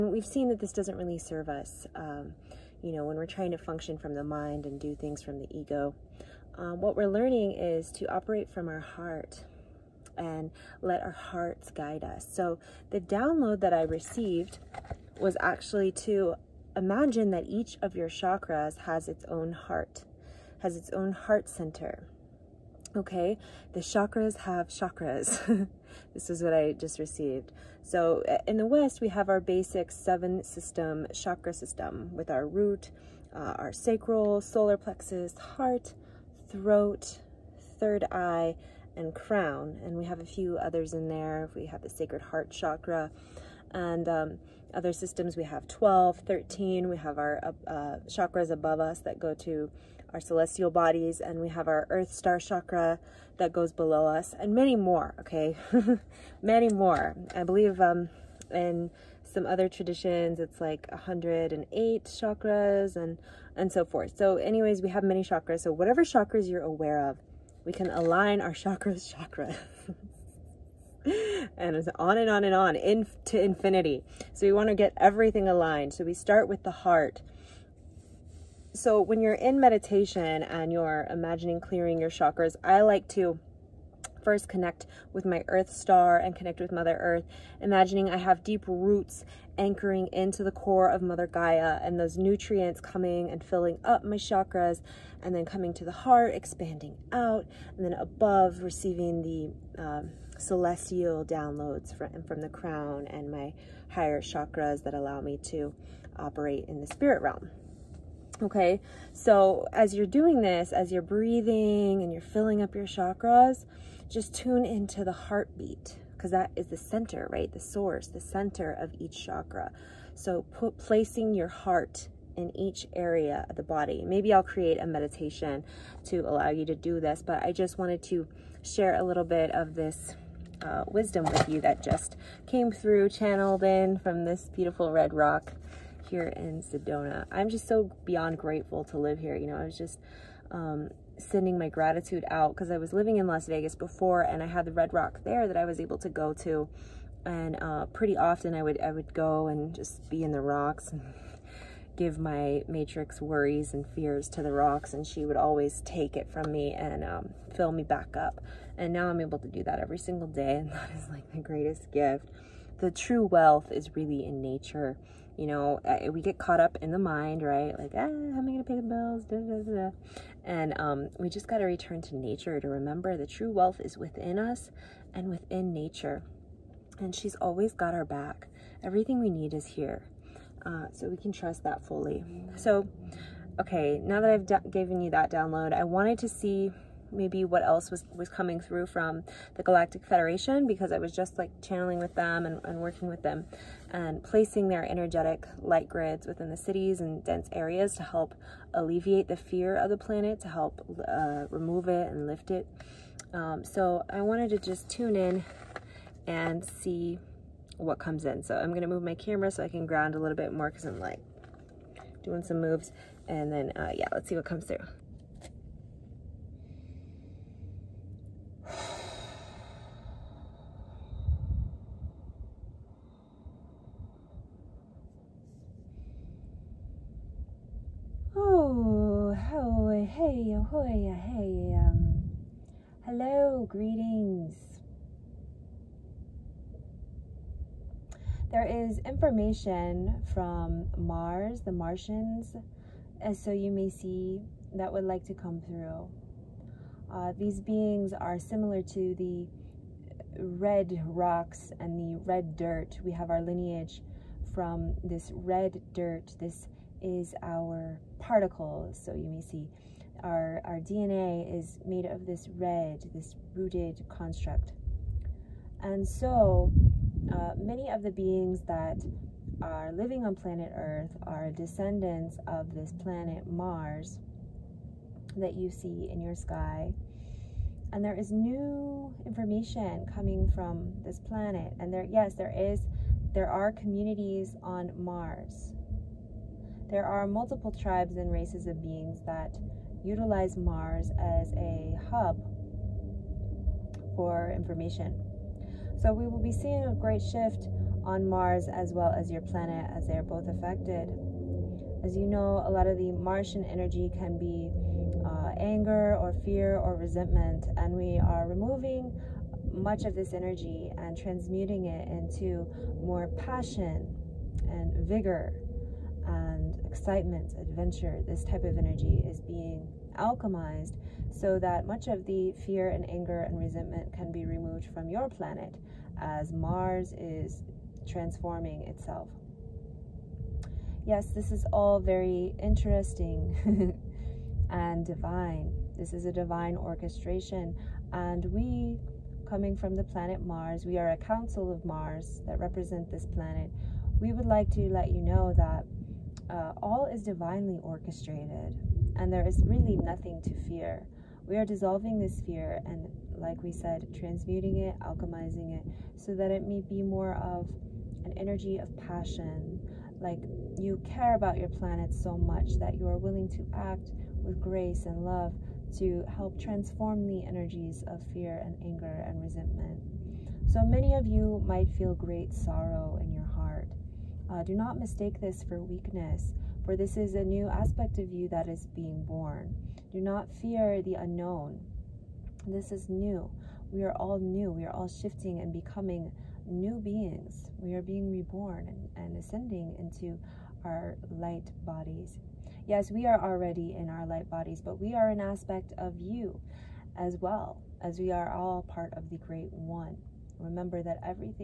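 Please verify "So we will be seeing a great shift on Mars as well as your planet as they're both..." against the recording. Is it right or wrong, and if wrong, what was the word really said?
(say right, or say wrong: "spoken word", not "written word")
right.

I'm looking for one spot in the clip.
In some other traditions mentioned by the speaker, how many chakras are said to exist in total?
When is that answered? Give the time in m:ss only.
1:00.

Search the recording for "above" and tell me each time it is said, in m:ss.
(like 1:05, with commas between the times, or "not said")
0:48, 1:37.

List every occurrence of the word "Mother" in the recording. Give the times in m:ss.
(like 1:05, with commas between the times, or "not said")
1:26, 1:30.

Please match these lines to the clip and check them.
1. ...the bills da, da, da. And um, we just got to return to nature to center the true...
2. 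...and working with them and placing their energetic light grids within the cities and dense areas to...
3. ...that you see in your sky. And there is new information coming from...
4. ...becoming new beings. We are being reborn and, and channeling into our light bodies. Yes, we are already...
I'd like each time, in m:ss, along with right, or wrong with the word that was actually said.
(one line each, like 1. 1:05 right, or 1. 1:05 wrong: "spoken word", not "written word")
1. 2:48 wrong: "remember", not "center"
2. 3:12 right
3. 4:35 right
4. 6:25 wrong: "ascending", not "channeling".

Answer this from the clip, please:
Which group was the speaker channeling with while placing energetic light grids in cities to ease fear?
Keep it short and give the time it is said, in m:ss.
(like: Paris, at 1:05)
Galactic Federation, at 3:09.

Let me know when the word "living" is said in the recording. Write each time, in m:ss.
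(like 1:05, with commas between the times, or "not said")
2:22, 4:29.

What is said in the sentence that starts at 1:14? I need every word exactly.
So we want to get everything aligned.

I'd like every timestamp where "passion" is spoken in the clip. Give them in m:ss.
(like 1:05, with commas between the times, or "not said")
5:13, 5:59.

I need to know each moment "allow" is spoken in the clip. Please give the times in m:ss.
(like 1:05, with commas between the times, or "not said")
1:44, 2:06.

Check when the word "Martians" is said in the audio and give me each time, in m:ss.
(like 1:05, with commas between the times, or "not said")
4:01, 5:03.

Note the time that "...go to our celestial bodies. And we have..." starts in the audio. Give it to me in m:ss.
0:49.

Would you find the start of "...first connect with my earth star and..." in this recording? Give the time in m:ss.
1:24.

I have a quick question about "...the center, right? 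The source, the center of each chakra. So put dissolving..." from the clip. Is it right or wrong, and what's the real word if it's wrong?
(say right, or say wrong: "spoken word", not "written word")
wrong: "placing", not "dissolving".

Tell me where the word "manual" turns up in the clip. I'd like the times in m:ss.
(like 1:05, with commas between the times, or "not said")
not said.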